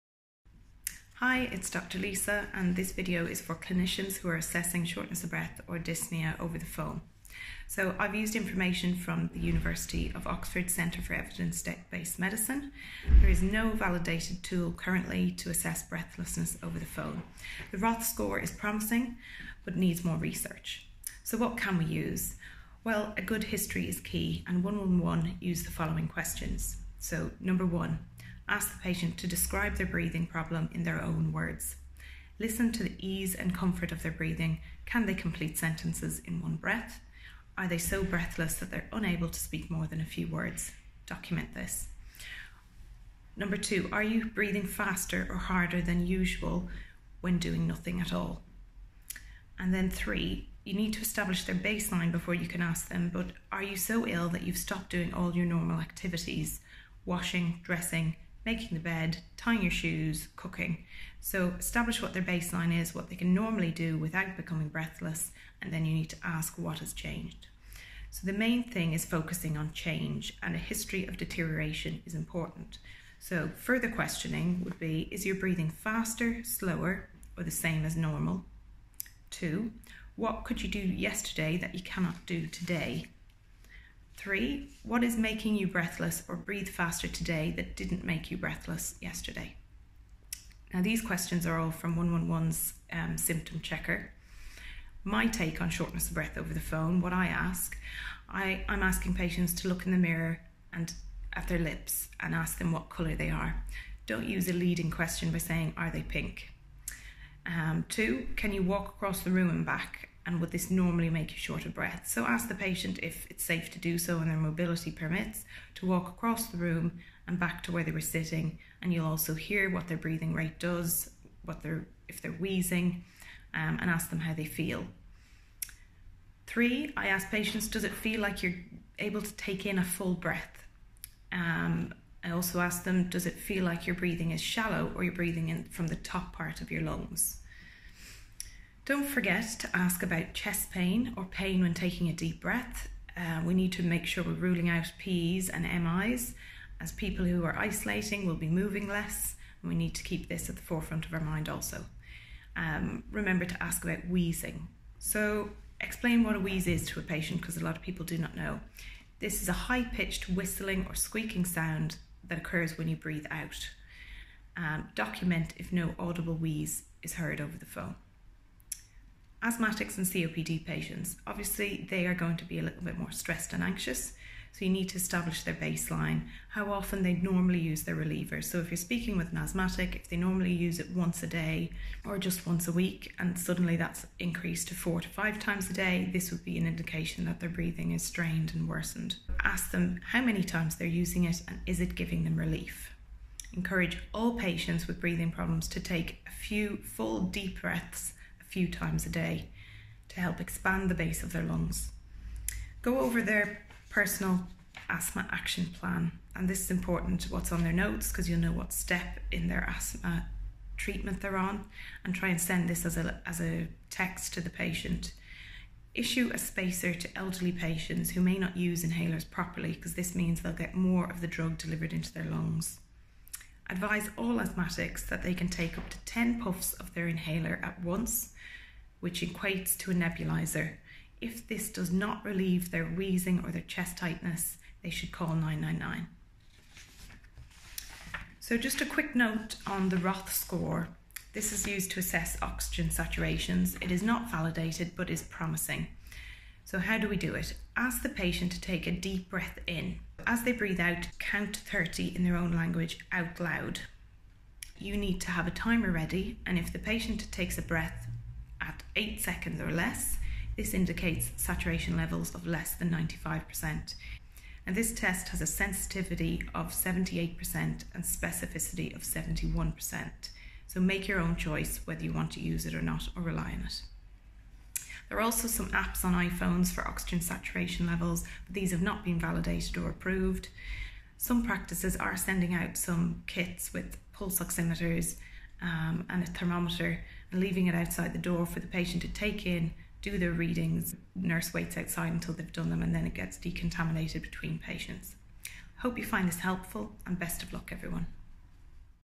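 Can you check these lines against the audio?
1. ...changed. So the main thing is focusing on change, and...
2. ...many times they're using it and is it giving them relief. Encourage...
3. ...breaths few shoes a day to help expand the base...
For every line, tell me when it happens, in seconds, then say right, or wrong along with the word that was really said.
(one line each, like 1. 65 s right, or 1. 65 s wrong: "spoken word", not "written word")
1. 66 s right
2. 190 s right
3. 197 s wrong: "times", not "shoes".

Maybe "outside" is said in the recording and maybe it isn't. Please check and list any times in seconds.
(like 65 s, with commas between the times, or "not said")
287 s, 291 s.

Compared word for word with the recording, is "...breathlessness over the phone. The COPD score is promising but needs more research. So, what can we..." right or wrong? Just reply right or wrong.
wrong.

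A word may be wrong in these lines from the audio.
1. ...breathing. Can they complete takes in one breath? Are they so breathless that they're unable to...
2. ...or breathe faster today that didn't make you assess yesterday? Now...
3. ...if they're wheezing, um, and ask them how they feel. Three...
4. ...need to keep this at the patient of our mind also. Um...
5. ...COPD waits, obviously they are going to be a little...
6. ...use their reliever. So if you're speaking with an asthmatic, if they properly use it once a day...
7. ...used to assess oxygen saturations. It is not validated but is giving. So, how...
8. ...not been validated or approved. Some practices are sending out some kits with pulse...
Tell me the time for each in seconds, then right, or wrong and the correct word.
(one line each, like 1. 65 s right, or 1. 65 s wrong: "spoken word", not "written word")
1. 34 s wrong: "sentences", not "takes"
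2. 86 s wrong: "breathless", not "assess"
3. 122 s right
4. 149 s wrong: "forefront", not "patient"
5. 170 s wrong: "patients", not "waits"
6. 177 s wrong: "normally", not "properly"
7. 241 s wrong: "promising", not "giving"
8. 278 s right.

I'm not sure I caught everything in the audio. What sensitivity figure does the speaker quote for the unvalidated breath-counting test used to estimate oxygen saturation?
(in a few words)
78%.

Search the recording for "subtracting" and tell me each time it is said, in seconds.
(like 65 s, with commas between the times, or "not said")
not said.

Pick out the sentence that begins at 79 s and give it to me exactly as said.
Two, what could you do yesterday that you cannot do today?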